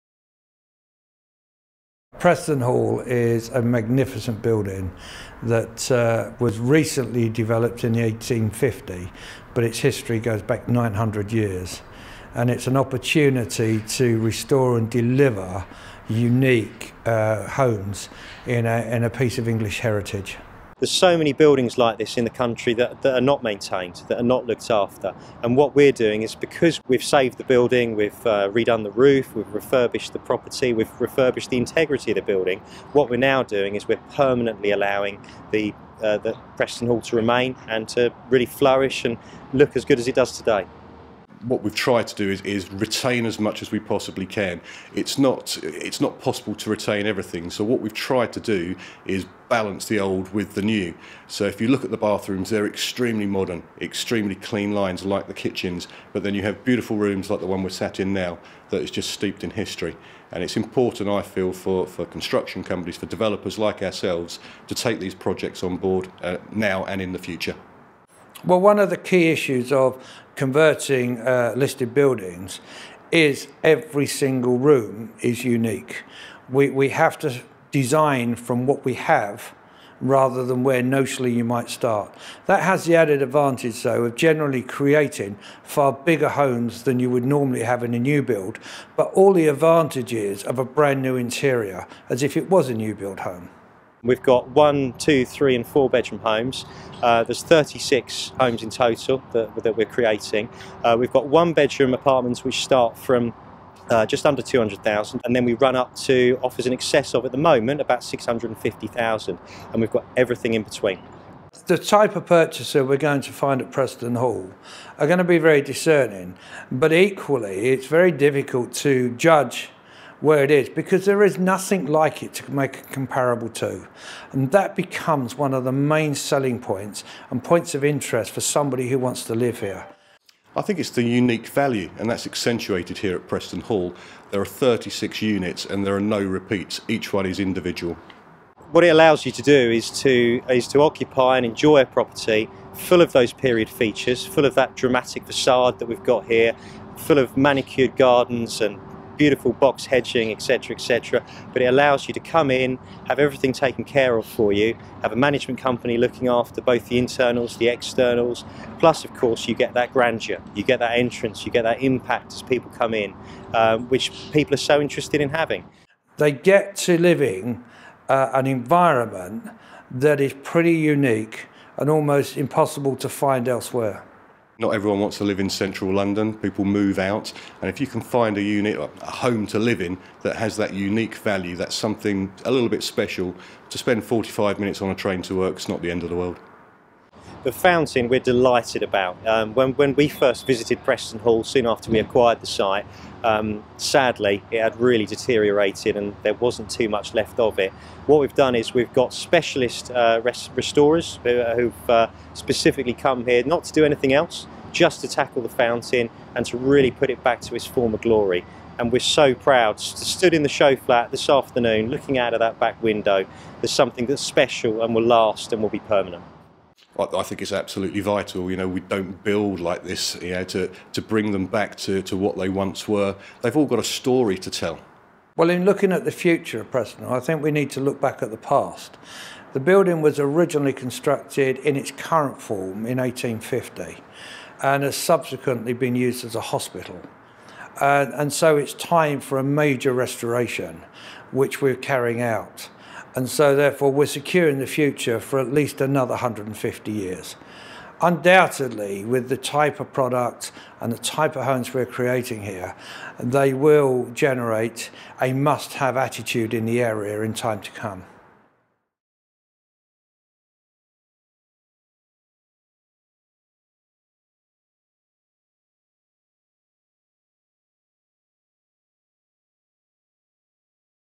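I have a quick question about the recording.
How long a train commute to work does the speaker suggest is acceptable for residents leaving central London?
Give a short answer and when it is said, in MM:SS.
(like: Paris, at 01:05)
45 minutes, at 03:04.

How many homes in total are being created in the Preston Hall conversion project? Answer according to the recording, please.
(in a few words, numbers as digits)
36.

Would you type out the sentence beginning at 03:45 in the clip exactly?
Well, in looking at the future of Preston, I think we need to look back at the past.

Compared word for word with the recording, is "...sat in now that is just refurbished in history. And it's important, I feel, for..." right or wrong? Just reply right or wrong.
wrong.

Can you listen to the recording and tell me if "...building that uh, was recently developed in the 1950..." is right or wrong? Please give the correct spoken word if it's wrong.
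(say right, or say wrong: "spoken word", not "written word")
wrong: "1850", not "1950".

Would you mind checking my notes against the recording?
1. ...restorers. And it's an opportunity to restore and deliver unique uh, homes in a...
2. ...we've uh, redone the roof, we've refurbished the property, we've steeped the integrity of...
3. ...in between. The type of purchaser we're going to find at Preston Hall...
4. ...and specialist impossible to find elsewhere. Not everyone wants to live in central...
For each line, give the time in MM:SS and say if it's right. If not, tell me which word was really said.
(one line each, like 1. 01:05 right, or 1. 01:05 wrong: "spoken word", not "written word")
1. 00:11 wrong: "years", not "restorers"
2. 00:27 wrong: "refurbished", not "steeped"
3. 01:50 right
4. 02:51 wrong: "almost", not "specialist".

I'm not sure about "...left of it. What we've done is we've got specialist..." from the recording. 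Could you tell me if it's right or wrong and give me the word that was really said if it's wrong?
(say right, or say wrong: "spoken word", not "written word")
right.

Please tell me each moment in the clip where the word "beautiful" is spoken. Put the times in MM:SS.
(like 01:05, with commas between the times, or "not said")
00:56, 02:29.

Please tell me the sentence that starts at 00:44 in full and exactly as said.
It's not it's not possible to retain everything.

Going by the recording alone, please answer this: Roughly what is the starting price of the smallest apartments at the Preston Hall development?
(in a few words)
just under 200,000.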